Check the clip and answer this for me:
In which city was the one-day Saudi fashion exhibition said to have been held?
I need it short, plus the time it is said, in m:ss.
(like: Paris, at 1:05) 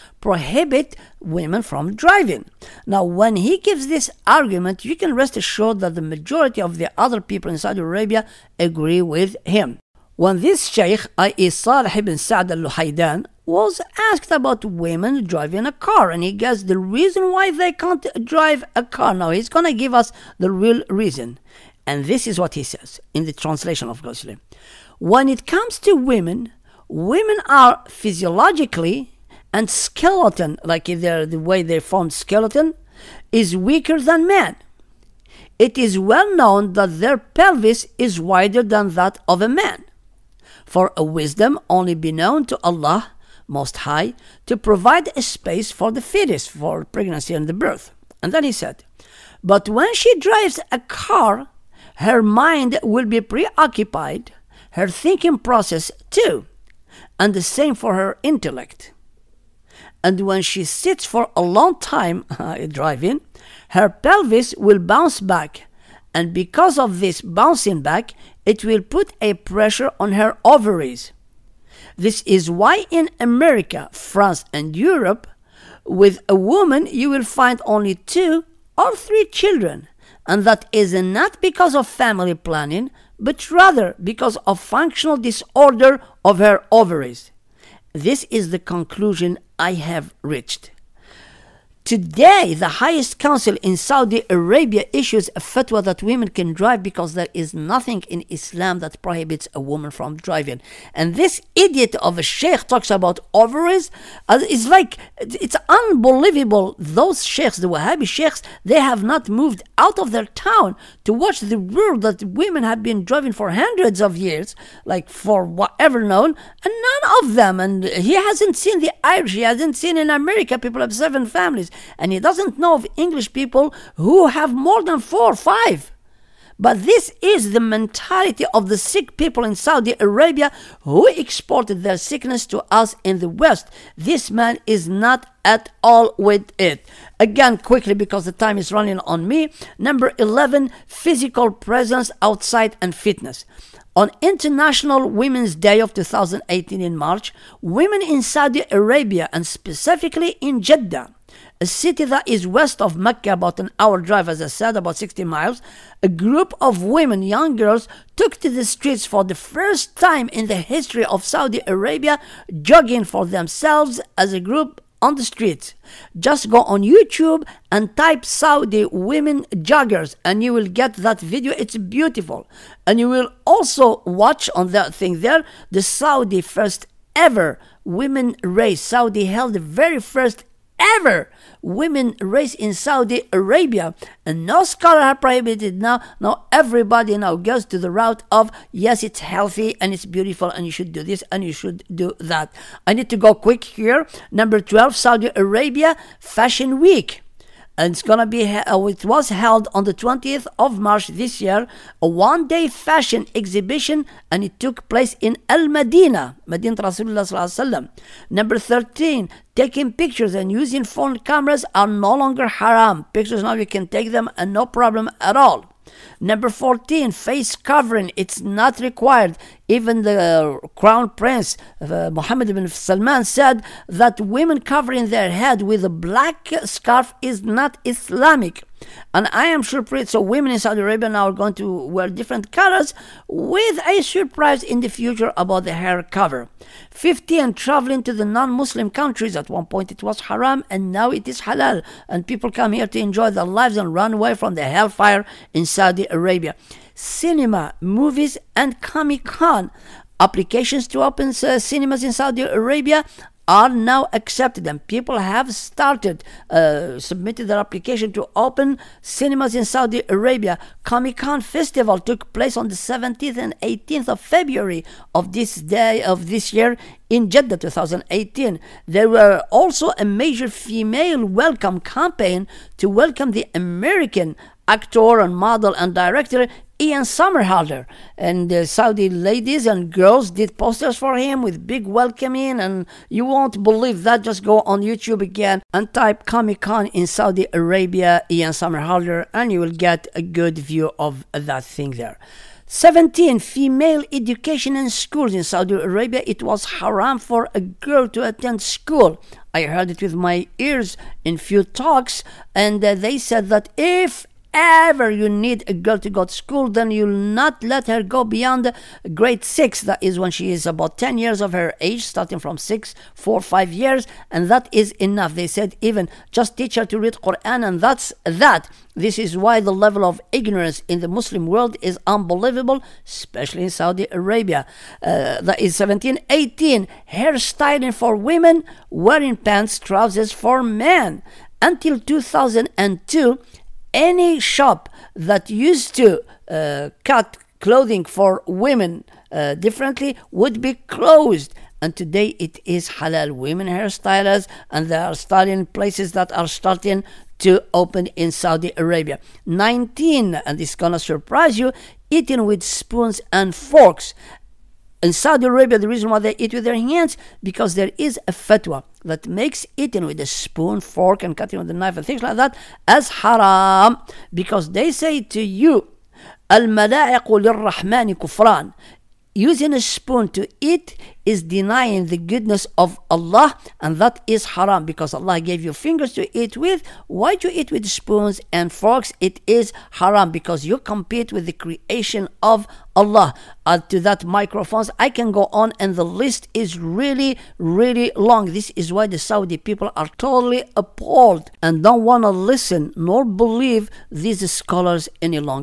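Al Madina, at 3:25.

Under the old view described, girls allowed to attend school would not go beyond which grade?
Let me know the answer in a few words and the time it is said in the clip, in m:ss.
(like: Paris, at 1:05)
grade 6, at 5:09.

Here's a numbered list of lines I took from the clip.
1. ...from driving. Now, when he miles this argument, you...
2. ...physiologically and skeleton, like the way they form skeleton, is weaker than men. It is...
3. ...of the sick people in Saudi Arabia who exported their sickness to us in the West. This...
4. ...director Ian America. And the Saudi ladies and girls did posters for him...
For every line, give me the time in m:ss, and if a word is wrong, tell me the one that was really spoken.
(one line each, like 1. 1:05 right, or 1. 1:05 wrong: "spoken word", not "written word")
1. 0:01 wrong: "gives", not "miles"
2. 0:27 right
3. 2:08 right
4. 4:35 wrong: "Somerhalder", not "America".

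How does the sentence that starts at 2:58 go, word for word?
Saudi held the very first ever women race in Saudi Arabia.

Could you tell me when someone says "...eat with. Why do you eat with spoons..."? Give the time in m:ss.
6:16.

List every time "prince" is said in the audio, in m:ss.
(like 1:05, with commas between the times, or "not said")
3:41.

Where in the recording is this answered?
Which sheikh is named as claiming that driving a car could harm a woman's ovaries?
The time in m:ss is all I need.
0:11.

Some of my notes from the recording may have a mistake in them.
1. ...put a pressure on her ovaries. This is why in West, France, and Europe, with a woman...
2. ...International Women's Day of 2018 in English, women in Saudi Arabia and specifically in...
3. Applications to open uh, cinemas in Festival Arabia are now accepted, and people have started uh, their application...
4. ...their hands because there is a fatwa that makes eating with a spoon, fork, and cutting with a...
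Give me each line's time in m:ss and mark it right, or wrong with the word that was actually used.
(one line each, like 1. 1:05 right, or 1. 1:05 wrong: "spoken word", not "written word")
1. 1:08 wrong: "America", not "West"
2. 2:24 wrong: "March", not "English"
3. 4:10 wrong: "Saudi", not "Festival"
4. 5:56 right.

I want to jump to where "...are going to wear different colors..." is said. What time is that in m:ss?
3:51.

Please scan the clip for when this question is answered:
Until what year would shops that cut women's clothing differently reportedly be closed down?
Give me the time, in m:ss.
5:31.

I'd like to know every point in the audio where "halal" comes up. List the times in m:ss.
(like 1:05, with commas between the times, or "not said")
4:01, 5:42.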